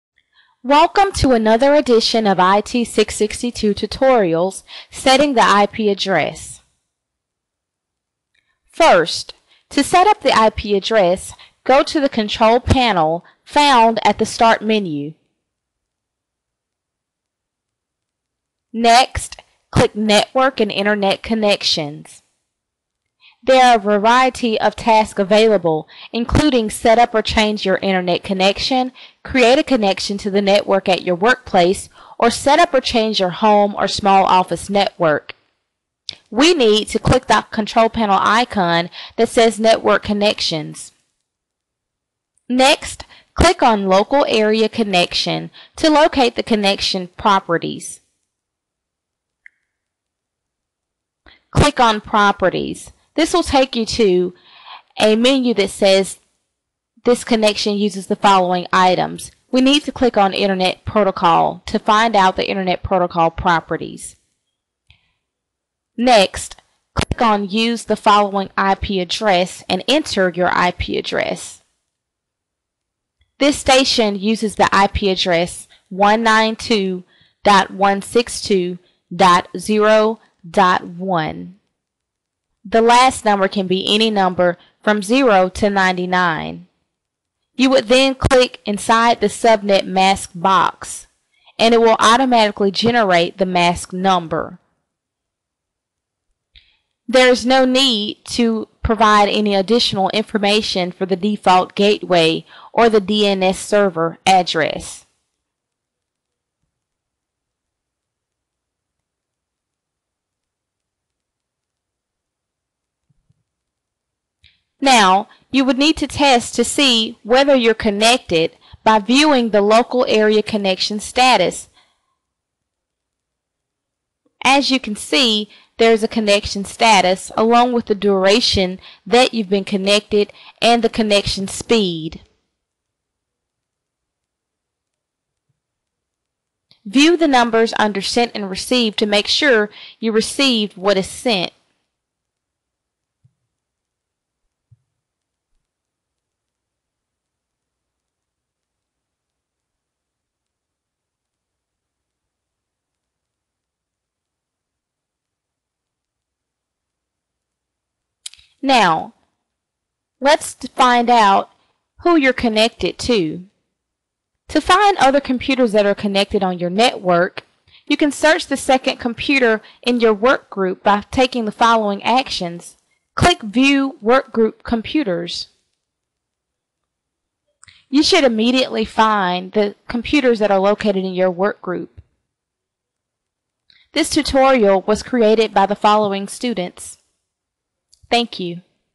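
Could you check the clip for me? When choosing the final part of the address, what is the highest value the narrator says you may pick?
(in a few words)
99.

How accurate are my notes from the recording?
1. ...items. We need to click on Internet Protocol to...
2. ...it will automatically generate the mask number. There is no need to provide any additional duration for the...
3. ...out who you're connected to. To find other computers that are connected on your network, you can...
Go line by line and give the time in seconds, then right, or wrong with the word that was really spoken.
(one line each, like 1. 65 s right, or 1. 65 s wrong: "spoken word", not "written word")
1. 58 s right
2. 91 s wrong: "information", not "duration"
3. 161 s right.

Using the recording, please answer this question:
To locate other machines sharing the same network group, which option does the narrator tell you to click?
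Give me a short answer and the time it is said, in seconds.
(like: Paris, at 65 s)
View Workgroup Computers, at 173 s.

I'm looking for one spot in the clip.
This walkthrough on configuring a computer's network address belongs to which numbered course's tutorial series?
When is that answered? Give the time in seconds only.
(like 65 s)
2 s.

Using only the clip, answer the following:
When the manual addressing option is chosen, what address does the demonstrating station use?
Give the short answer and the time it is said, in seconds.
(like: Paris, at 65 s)
192.162.0.1, at 75 s.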